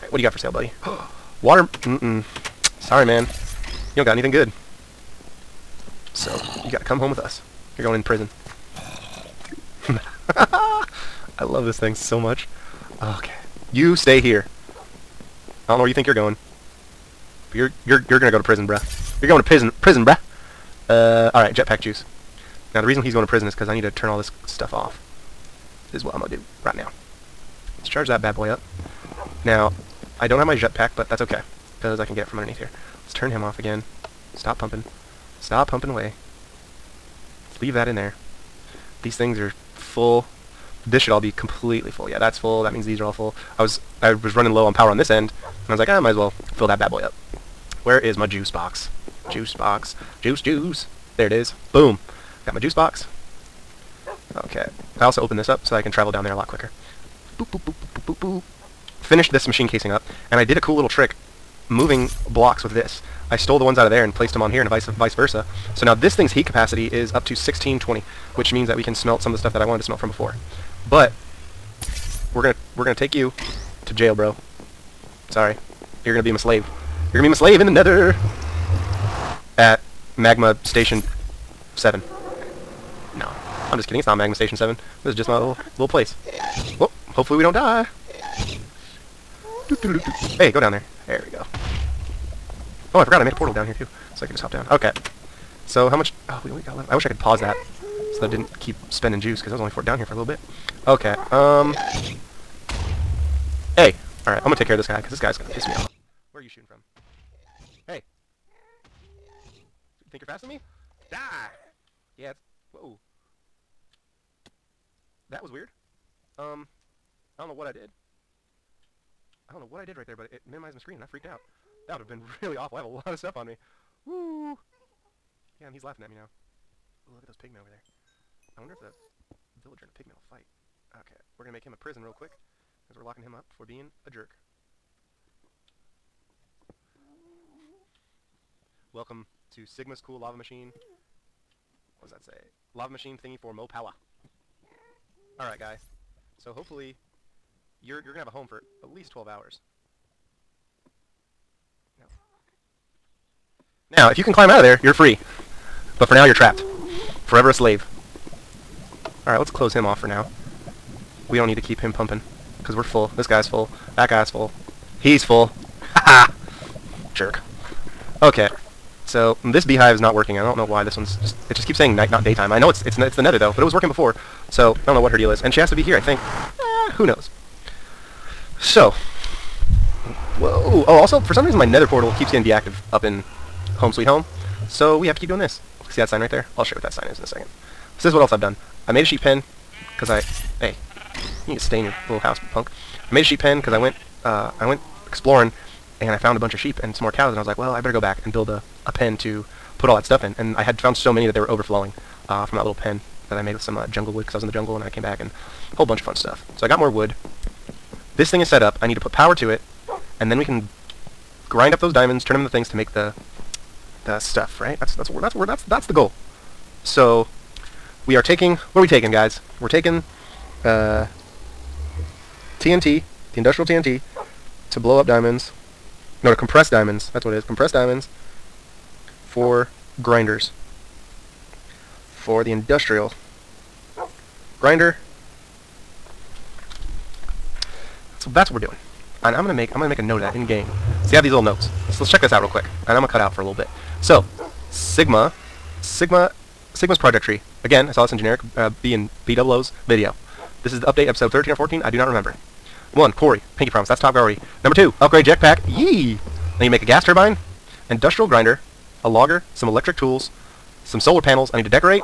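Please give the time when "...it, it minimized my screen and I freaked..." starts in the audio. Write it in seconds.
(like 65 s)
120 s.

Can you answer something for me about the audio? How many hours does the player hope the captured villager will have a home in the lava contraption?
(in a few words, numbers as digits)
12 hours.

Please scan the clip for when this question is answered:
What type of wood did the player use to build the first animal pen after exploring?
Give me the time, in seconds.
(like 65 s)
203 s.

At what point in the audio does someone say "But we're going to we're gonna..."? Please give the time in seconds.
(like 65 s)
70 s.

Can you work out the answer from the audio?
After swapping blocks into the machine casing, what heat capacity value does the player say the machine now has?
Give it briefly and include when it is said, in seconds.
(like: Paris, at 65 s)
1620, at 67 s.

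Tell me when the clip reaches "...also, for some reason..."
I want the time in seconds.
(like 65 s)
181 s.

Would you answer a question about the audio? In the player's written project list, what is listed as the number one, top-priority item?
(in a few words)
quarry.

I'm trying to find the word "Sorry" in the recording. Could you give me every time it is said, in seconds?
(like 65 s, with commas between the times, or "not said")
2 s, 75 s.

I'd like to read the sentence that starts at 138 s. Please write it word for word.
Welcome to Sigma's Cool Lava Machine.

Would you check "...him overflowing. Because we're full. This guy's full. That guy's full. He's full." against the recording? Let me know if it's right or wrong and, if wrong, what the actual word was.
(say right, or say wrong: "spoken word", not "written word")
wrong: "pumping", not "overflowing".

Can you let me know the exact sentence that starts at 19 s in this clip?
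You're going to prison, prison, bruh.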